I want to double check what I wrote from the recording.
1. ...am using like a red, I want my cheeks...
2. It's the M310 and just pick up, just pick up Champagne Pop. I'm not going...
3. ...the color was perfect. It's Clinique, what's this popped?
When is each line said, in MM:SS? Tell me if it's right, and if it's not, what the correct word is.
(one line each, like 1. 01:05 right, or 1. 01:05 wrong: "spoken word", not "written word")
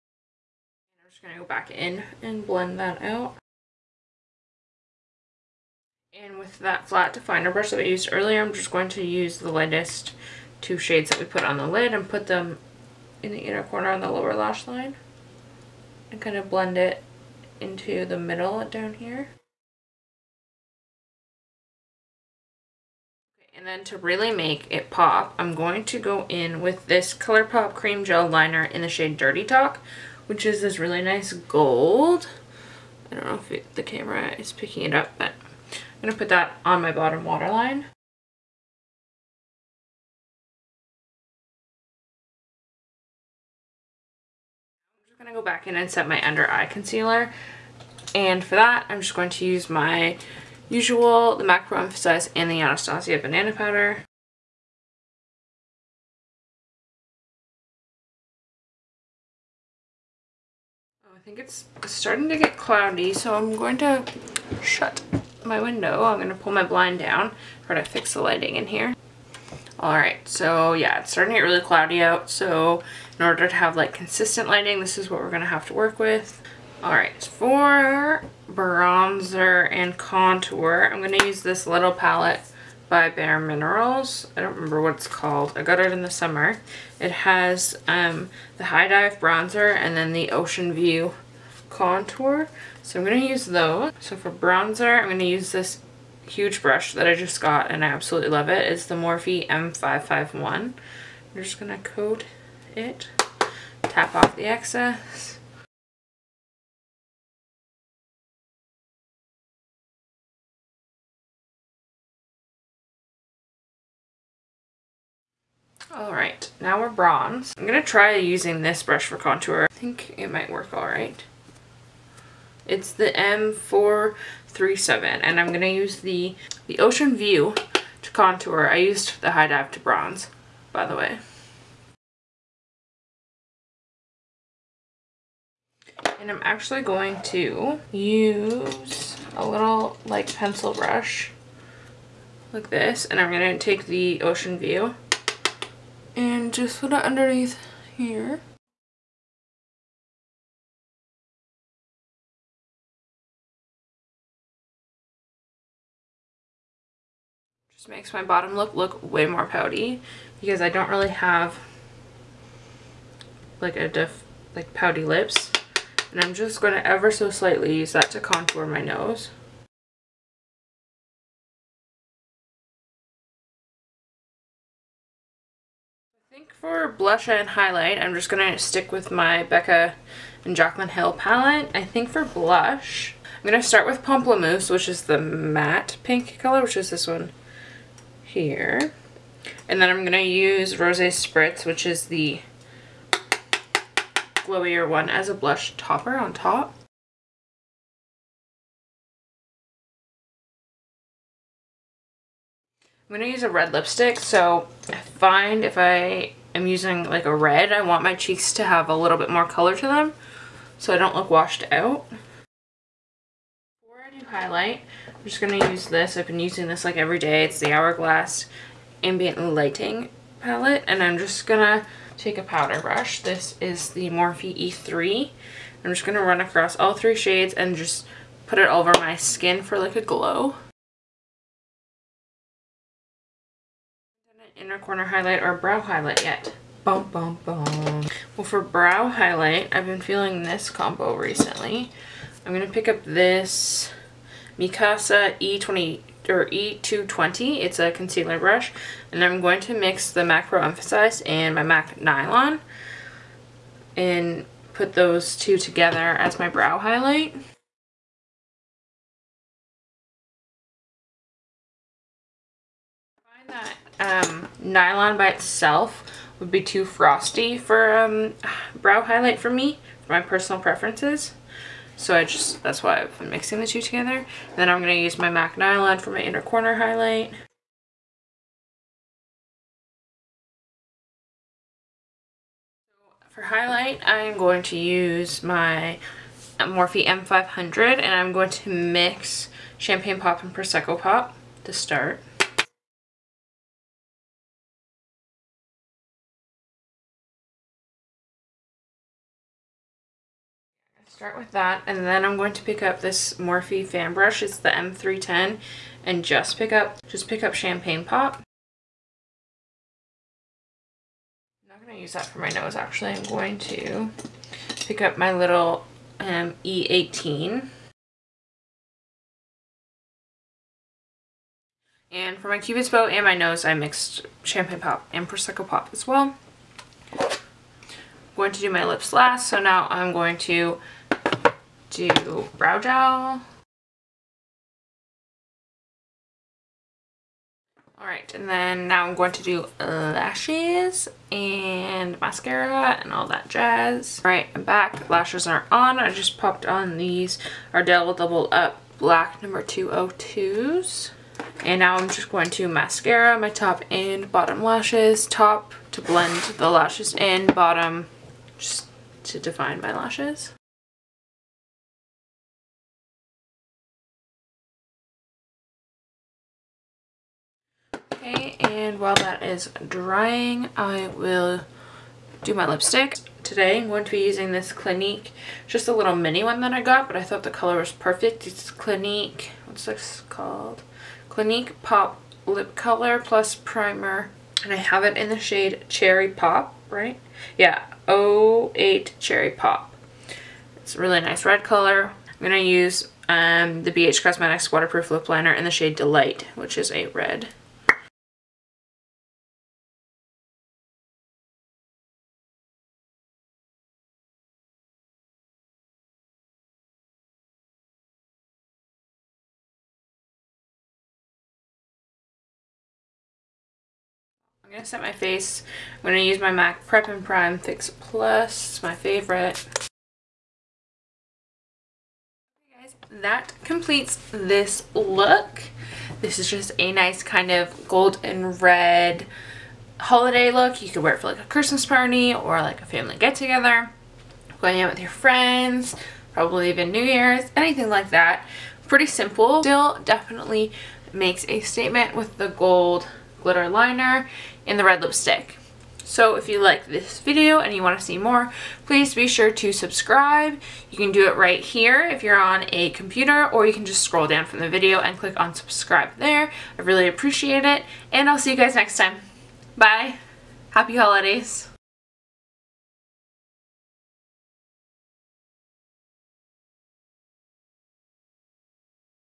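1. 03:26 right
2. 05:04 right
3. 06:17 wrong: "called", not "popped".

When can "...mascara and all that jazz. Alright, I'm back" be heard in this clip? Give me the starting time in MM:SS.
05:42.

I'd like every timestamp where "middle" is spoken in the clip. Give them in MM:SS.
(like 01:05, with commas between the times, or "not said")
00:18.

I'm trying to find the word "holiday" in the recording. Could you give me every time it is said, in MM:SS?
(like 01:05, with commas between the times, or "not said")
07:10, 07:40.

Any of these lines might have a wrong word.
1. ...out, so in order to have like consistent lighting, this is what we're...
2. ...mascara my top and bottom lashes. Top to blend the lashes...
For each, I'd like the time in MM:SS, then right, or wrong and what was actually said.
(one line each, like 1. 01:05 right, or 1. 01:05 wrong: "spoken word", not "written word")
1. 01:12 right
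2. 05:52 right.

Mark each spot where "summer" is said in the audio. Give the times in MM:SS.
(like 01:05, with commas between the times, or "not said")
01:26.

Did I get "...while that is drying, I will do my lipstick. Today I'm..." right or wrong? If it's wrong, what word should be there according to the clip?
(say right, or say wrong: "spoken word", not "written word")
right.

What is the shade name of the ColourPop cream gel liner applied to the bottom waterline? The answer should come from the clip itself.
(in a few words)
Dirty Talk.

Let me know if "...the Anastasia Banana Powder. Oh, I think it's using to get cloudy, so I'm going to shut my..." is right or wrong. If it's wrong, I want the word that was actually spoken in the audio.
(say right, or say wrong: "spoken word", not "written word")
wrong: "starting", not "using".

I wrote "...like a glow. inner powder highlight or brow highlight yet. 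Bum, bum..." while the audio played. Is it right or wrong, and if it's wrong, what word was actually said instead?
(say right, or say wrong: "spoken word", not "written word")
wrong: "corner", not "powder".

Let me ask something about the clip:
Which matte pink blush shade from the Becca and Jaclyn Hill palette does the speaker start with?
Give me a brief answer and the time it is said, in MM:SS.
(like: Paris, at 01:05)
Pamplemousse, at 03:04.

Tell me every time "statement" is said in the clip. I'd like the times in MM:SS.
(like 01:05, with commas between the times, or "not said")
07:21.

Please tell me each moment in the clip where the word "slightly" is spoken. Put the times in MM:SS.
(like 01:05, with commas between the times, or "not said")
02:47.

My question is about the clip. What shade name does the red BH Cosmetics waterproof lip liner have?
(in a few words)
Delight.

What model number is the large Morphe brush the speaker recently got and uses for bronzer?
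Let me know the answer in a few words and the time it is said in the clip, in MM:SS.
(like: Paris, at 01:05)
M551, at 01:39.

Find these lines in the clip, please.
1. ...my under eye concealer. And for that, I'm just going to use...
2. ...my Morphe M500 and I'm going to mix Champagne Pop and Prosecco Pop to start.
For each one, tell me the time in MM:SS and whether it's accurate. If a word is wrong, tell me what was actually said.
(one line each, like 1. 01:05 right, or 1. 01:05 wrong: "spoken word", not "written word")
1. 00:46 right
2. 04:45 right.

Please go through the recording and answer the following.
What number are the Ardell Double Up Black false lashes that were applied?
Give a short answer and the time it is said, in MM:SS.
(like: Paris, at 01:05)
202, at 05:49.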